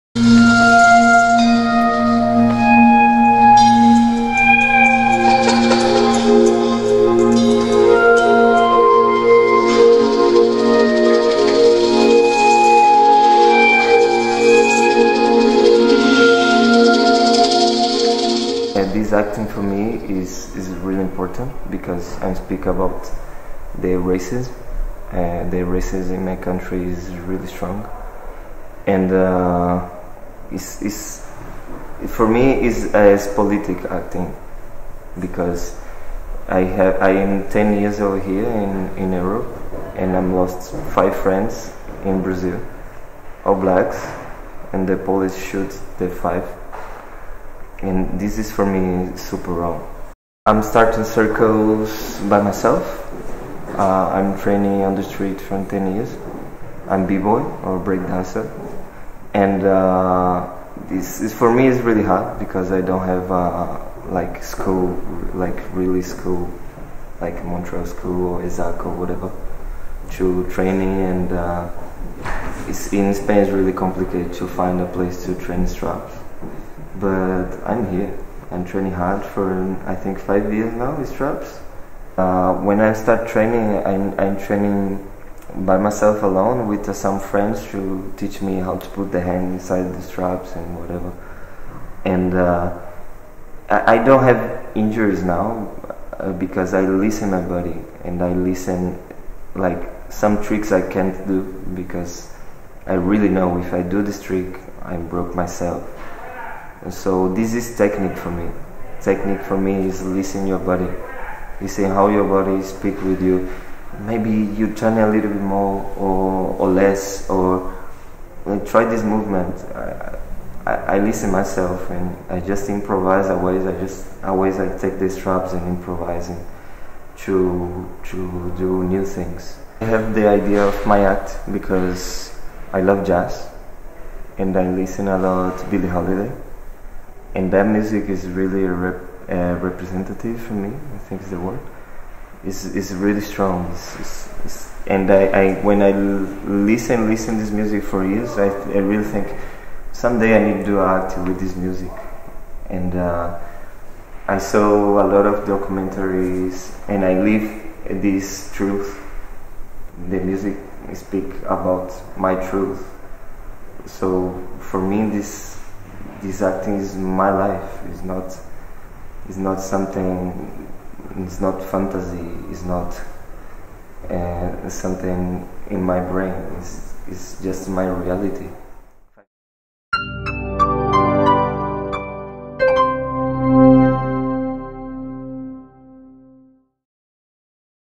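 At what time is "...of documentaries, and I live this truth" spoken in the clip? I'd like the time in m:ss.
2:35.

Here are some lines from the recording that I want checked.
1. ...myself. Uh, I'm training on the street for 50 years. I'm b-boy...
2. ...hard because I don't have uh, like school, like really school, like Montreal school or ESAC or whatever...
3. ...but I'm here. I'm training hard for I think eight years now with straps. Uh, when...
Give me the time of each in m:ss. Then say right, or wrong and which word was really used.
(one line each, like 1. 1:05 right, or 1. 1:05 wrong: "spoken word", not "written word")
1. 0:52 wrong: "10", not "50"
2. 1:02 right
3. 1:16 wrong: "five", not "eight".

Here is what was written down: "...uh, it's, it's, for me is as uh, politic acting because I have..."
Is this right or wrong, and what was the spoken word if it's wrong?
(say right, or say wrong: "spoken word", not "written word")
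right.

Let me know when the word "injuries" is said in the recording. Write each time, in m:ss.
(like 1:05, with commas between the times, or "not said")
1:34.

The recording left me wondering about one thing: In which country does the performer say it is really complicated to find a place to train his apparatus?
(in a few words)
Spain.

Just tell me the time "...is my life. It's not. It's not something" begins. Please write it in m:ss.
2:46.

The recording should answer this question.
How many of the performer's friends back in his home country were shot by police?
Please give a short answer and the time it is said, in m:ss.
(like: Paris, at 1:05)
5, at 0:40.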